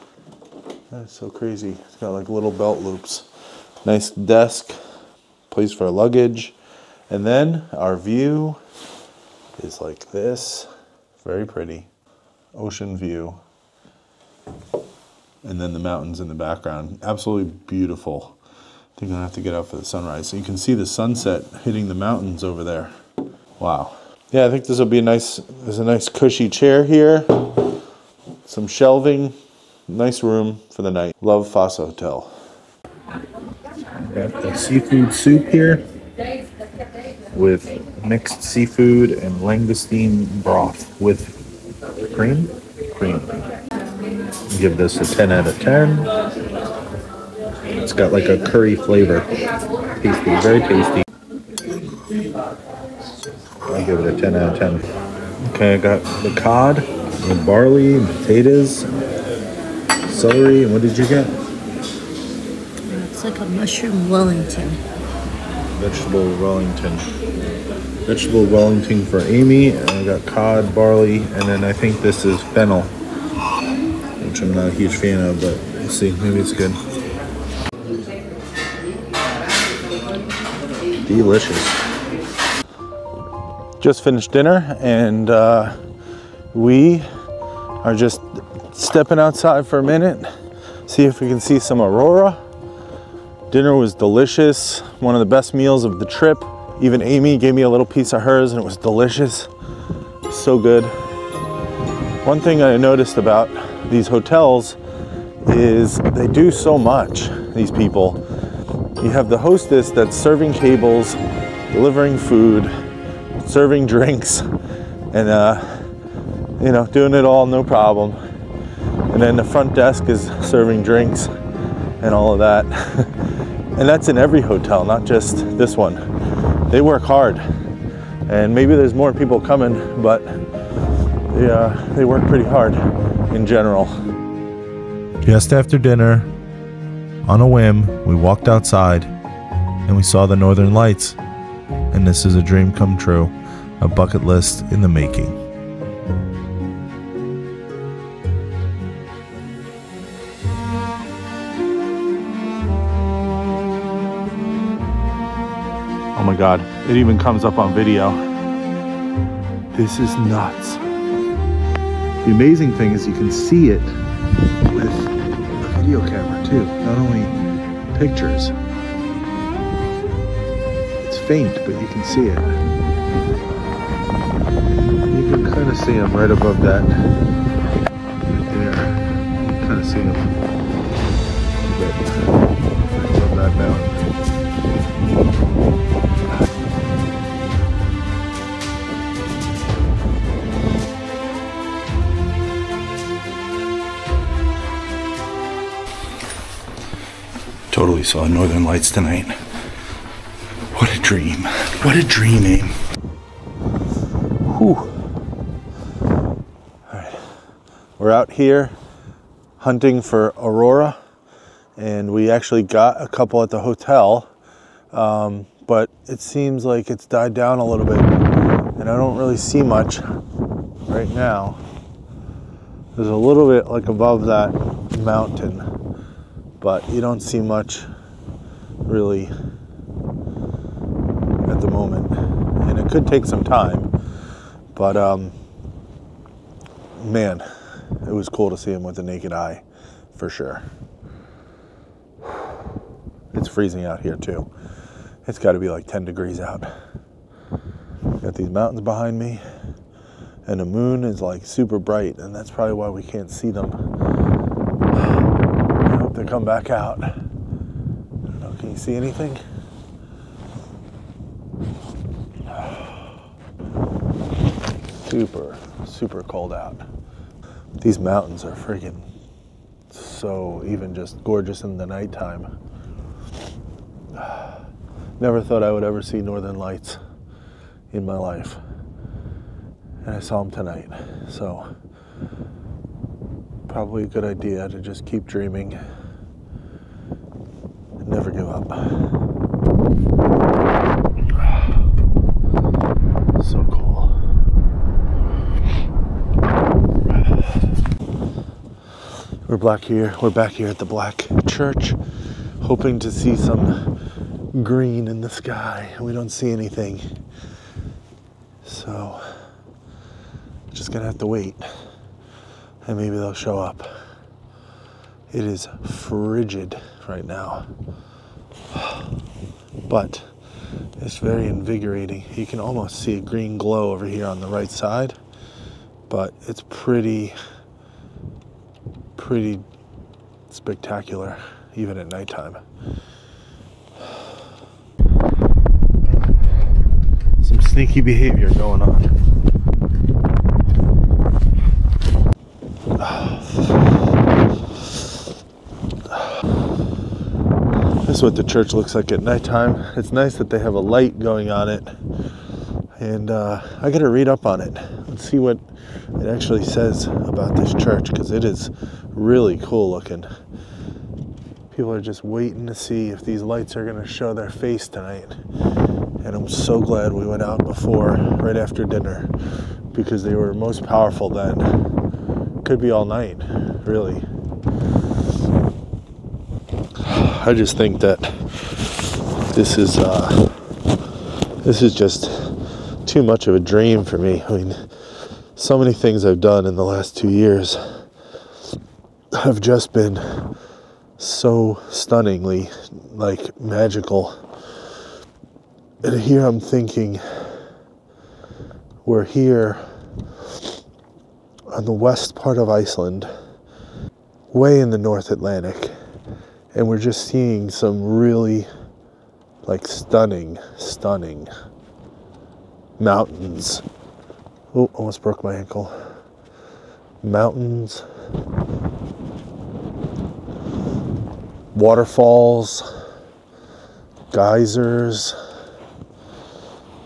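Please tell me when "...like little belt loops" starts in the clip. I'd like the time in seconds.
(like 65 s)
2 s.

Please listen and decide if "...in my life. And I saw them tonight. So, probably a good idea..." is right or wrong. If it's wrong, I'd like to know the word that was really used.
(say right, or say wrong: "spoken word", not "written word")
right.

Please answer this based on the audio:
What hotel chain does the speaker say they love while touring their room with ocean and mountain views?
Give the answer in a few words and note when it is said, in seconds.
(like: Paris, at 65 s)
Fosshotel, at 31 s.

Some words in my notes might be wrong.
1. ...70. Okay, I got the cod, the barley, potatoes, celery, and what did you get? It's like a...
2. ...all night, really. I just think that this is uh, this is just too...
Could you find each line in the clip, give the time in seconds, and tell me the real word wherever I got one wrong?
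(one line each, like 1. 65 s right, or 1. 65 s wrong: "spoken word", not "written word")
1. 54 s wrong: "10", not "70"
2. 372 s right.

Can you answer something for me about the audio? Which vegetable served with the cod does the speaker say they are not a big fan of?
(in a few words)
Fennel.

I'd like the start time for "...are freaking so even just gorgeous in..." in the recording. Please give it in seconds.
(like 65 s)
268 s.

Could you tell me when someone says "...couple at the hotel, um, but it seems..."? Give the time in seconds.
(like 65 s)
213 s.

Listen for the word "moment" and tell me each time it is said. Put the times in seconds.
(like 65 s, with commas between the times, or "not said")
231 s.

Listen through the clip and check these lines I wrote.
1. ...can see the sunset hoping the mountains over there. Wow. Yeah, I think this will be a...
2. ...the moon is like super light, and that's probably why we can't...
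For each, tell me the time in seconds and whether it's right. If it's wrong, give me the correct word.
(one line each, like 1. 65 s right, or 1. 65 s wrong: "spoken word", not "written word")
1. 20 s wrong: "hitting", not "hoping"
2. 250 s wrong: "bright", not "light".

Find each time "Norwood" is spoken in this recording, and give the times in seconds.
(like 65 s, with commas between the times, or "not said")
not said.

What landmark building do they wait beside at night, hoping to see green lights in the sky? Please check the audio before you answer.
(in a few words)
Black Church.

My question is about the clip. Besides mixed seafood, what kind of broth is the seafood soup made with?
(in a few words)
Langoustine broth.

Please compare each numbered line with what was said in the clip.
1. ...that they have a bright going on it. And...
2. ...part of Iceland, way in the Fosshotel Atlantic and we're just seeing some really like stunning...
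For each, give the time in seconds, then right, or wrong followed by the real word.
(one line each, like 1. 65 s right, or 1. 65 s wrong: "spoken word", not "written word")
1. 350 s wrong: "light", not "bright"
2. 402 s wrong: "North", not "Fosshotel".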